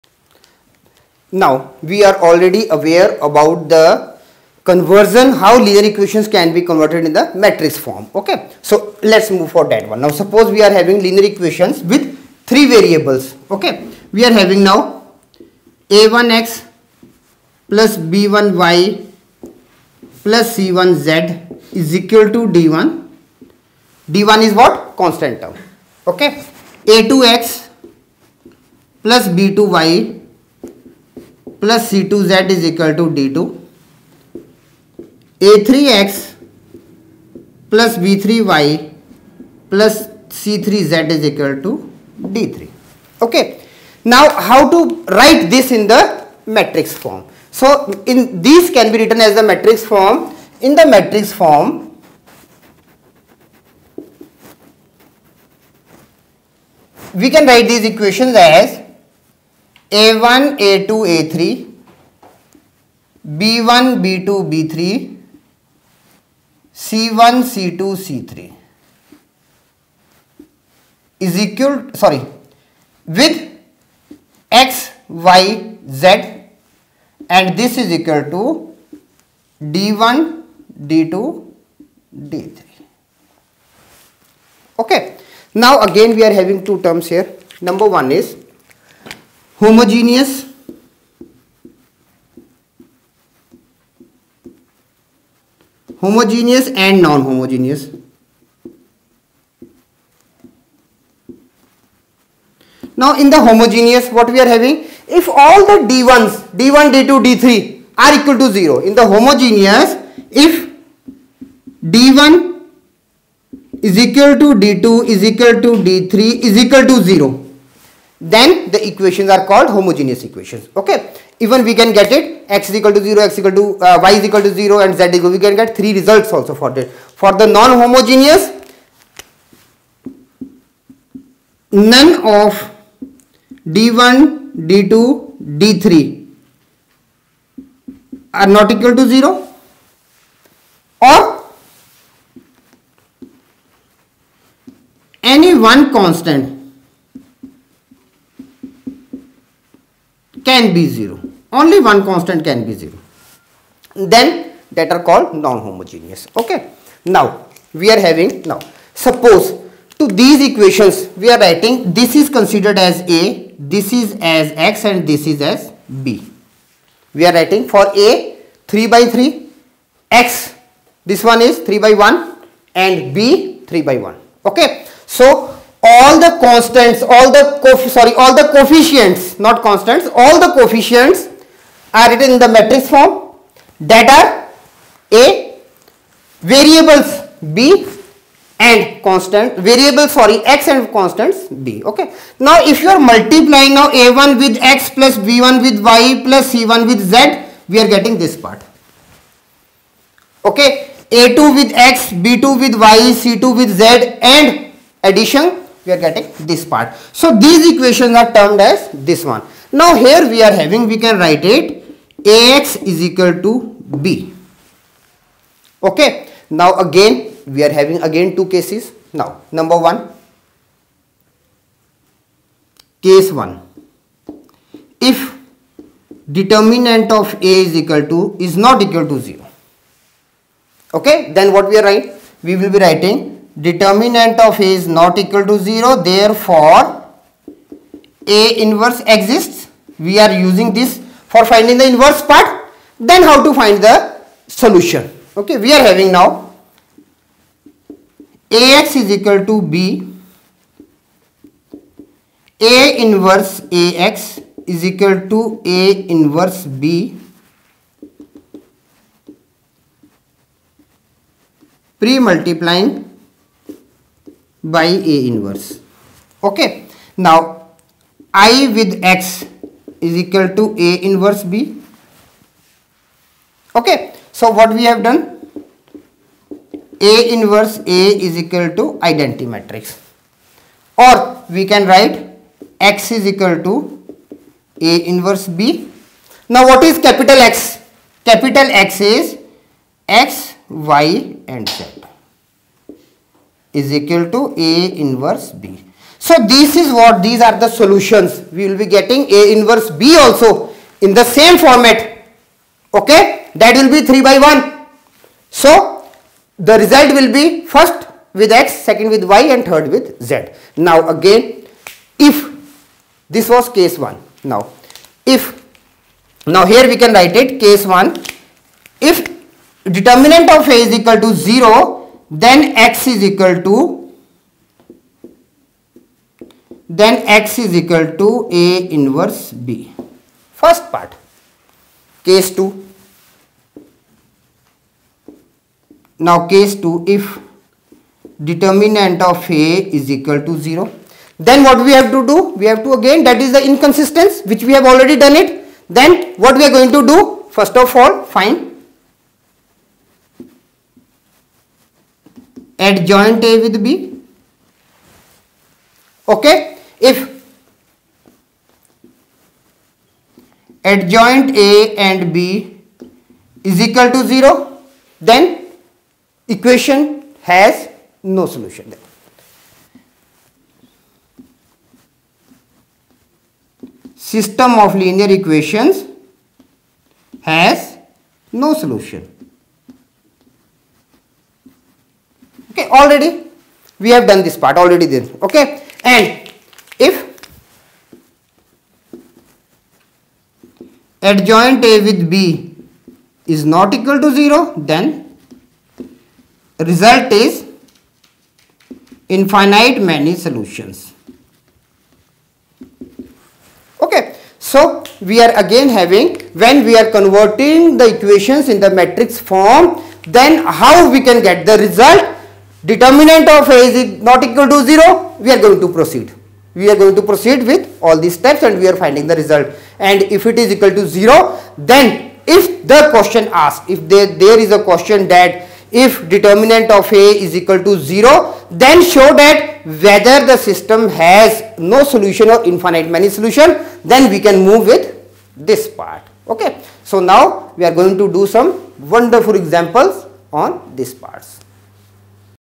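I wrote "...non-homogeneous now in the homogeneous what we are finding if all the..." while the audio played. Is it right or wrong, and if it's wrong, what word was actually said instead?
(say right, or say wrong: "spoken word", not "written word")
wrong: "having", not "finding".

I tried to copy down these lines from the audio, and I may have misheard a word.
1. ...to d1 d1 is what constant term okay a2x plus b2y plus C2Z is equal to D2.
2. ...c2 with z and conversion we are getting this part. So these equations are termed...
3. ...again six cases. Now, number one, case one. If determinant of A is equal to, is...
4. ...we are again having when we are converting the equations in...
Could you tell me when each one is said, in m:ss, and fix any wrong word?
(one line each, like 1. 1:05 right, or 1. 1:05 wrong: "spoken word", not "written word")
1. 0:22 right
2. 3:23 wrong: "addition", not "conversion"
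3. 3:38 wrong: "two", not "six"
4. 6:45 right.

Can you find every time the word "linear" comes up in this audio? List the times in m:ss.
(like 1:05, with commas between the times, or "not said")
0:05, 0:11, 6:14.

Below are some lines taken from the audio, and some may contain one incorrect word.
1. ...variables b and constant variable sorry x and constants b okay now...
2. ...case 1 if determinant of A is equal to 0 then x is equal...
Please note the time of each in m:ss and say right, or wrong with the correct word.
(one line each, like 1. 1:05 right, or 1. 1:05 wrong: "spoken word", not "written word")
1. 3:06 right
2. 5:17 right.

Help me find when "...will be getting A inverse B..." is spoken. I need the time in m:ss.
4:58.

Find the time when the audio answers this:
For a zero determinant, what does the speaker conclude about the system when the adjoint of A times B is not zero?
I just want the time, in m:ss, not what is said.
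6:39.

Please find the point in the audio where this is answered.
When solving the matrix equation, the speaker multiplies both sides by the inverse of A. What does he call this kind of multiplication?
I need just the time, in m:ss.
4:21.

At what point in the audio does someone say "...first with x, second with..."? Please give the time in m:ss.
5:07.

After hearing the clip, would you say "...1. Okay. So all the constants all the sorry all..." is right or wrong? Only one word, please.
right.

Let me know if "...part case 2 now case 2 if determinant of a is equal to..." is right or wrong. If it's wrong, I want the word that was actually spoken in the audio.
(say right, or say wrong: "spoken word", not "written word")
right.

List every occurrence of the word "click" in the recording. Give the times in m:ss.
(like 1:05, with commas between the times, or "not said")
not said.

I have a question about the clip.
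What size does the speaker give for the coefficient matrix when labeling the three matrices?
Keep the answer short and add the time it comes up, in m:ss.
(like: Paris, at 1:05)
3 by 3, at 2:48.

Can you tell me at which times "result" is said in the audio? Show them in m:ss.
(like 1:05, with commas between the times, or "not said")
2:05, 5:06, 6:36, 6:51, 6:59.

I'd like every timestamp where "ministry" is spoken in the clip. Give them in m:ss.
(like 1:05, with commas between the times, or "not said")
not said.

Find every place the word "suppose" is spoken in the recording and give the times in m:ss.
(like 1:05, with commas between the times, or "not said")
0:10, 2:38.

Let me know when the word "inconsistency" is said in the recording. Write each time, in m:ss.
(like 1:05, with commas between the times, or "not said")
5:43.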